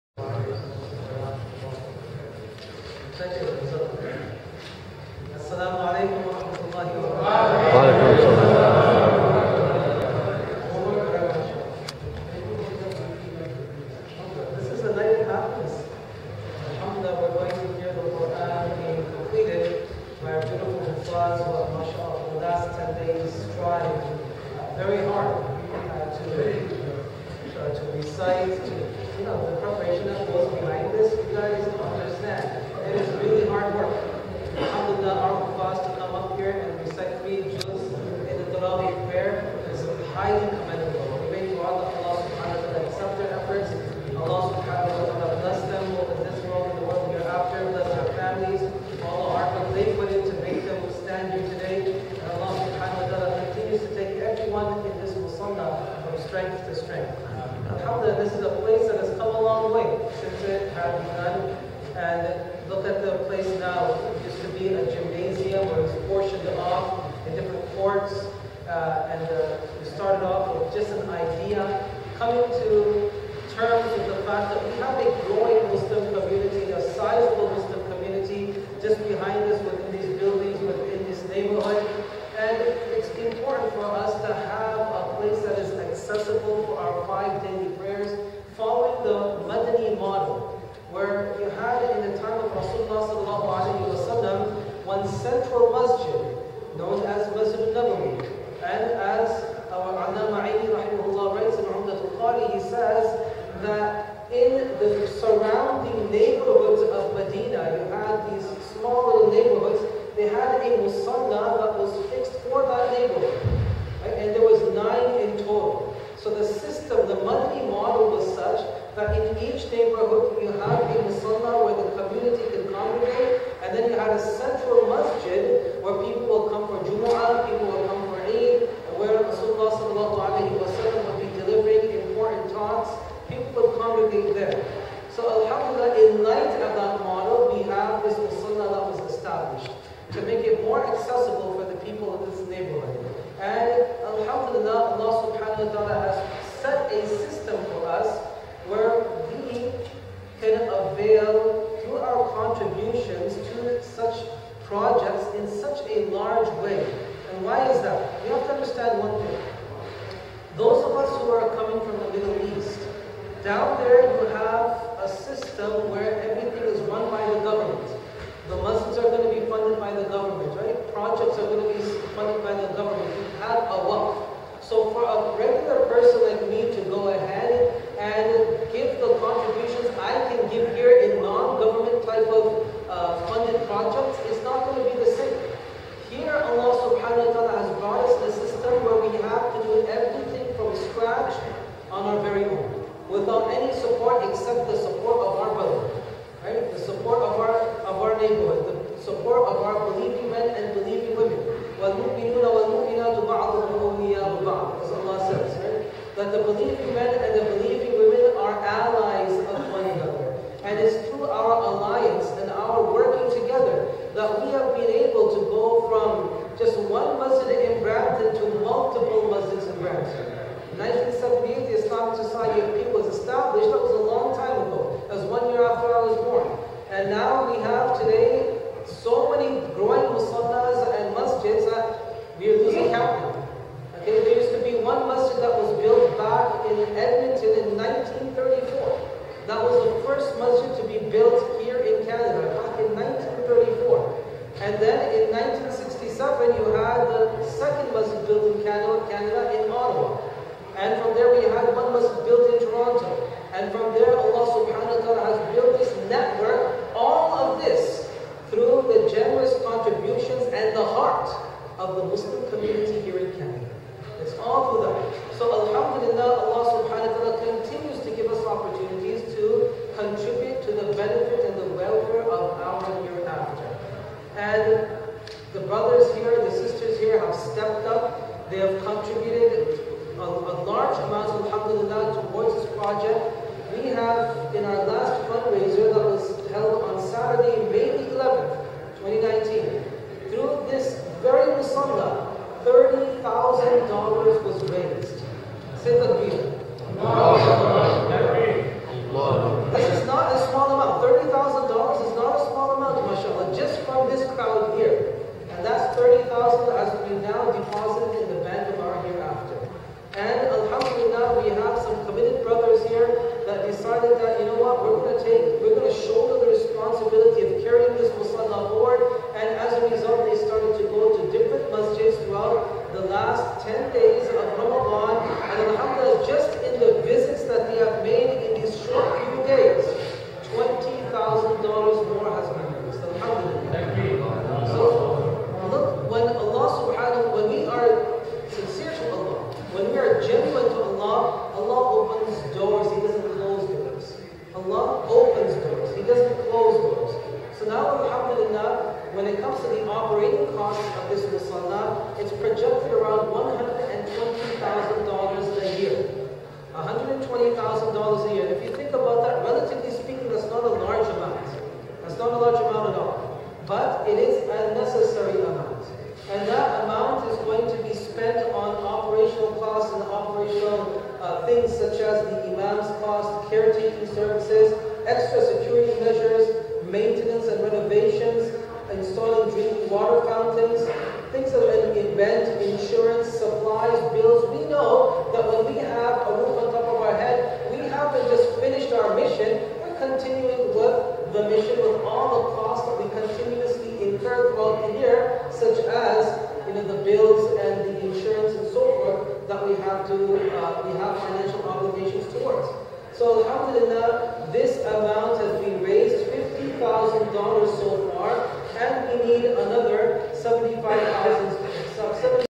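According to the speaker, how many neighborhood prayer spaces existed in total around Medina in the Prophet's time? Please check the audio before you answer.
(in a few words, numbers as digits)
9.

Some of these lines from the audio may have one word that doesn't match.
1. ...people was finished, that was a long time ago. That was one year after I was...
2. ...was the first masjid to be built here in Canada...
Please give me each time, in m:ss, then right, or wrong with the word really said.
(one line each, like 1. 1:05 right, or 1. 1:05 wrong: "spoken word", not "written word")
1. 3:42 wrong: "established", not "finished"
2. 3:59 right.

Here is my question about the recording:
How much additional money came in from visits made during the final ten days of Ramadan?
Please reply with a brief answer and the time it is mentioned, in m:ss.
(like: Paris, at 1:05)
$20,000, at 5:30.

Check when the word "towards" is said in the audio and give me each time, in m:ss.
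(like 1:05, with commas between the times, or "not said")
4:42, 6:42.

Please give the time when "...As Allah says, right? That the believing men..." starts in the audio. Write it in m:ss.
3:24.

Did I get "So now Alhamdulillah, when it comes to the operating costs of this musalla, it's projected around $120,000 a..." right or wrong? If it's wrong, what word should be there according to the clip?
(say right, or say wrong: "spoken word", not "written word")
right.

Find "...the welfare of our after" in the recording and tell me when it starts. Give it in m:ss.
4:31.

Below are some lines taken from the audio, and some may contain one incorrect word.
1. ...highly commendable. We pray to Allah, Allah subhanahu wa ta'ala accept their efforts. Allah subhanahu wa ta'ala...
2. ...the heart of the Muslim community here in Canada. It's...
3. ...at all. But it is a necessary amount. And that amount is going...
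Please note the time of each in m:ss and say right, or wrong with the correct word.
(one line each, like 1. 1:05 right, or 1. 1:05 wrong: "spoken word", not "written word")
1. 0:40 right
2. 4:20 right
3. 6:02 right.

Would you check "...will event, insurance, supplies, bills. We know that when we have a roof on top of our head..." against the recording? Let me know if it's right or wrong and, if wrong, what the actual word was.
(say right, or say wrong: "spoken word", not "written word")
right.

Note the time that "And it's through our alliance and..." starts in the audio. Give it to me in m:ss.
3:30.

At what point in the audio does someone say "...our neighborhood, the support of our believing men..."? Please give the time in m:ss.
3:18.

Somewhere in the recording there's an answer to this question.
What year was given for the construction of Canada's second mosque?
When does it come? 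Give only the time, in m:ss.
4:05.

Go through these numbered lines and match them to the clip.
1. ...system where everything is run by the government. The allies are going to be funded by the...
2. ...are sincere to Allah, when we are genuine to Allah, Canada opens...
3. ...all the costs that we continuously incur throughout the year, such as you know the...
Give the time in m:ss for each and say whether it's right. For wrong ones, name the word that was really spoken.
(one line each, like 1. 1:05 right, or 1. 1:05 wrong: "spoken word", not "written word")
1. 2:45 wrong: "mosques", not "allies"
2. 5:37 wrong: "Allah", not "Canada"
3. 6:32 right.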